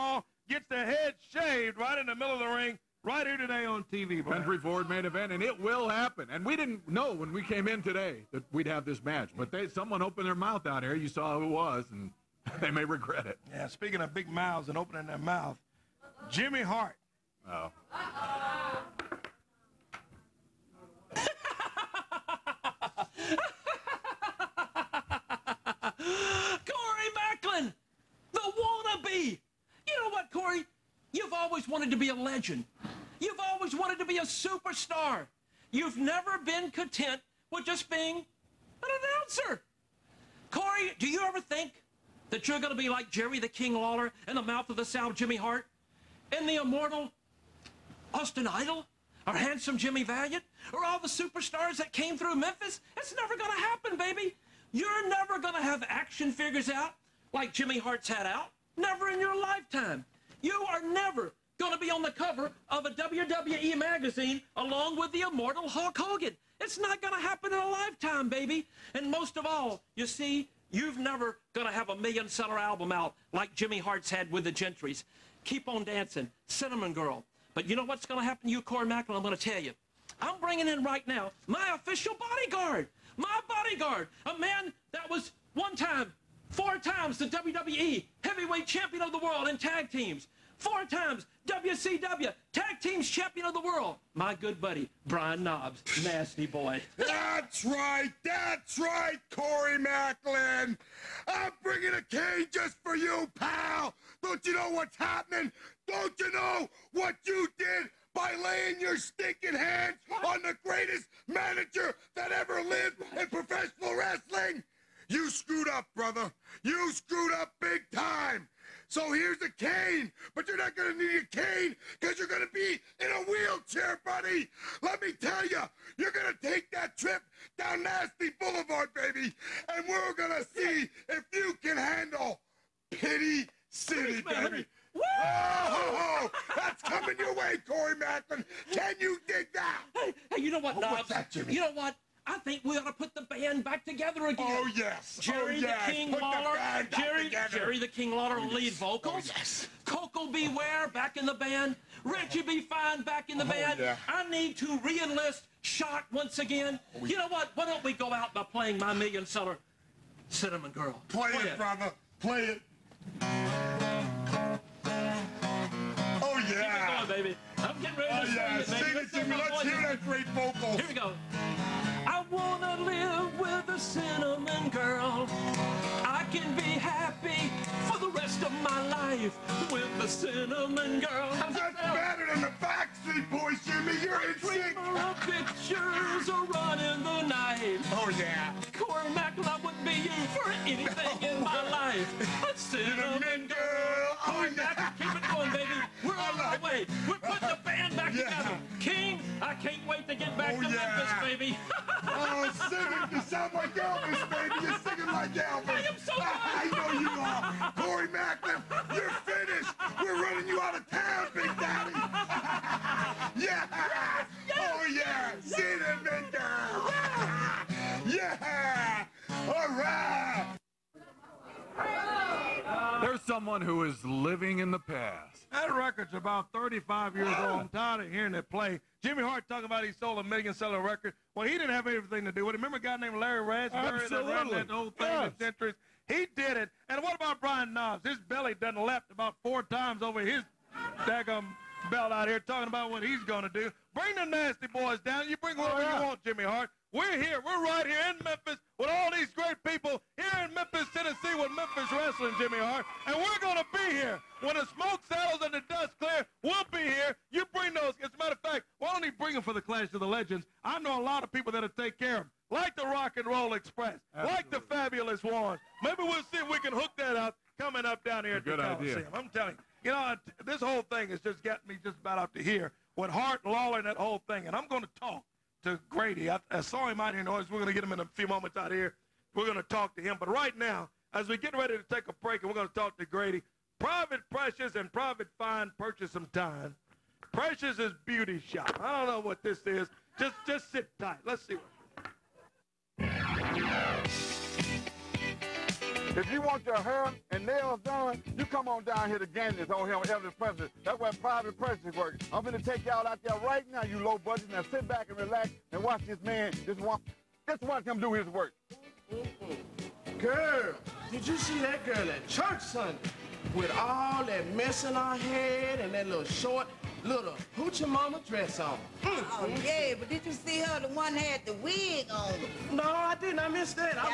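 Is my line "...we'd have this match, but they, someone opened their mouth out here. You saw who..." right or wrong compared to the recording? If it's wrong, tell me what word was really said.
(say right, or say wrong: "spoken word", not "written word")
right.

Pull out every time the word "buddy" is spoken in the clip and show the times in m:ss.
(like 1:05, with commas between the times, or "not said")
1:34, 2:04.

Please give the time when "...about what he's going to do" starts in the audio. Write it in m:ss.
4:02.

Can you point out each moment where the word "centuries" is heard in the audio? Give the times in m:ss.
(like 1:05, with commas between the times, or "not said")
3:55.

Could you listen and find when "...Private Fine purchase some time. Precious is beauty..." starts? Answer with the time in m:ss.
4:44.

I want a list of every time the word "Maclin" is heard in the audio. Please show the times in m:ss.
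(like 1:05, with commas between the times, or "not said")
1:18, 1:39, 2:17, 3:28.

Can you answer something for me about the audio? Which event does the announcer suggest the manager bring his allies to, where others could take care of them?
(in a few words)
Clash of the Legends.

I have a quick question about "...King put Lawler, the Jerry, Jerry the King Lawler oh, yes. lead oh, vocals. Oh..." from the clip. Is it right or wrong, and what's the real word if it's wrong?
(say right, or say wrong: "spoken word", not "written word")
right.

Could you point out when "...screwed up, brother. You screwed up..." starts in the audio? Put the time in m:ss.
1:55.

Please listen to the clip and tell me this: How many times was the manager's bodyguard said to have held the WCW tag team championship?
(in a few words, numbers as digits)
4.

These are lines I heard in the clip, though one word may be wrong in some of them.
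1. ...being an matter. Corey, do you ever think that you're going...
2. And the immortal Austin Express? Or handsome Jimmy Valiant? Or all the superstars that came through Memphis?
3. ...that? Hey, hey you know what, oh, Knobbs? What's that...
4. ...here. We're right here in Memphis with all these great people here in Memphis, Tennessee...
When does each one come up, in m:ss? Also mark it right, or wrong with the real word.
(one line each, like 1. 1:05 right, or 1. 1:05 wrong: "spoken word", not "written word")
1. 0:37 wrong: "announcer", not "matter"
2. 0:46 wrong: "Idol", not "Express"
3. 2:19 right
4. 4:07 right.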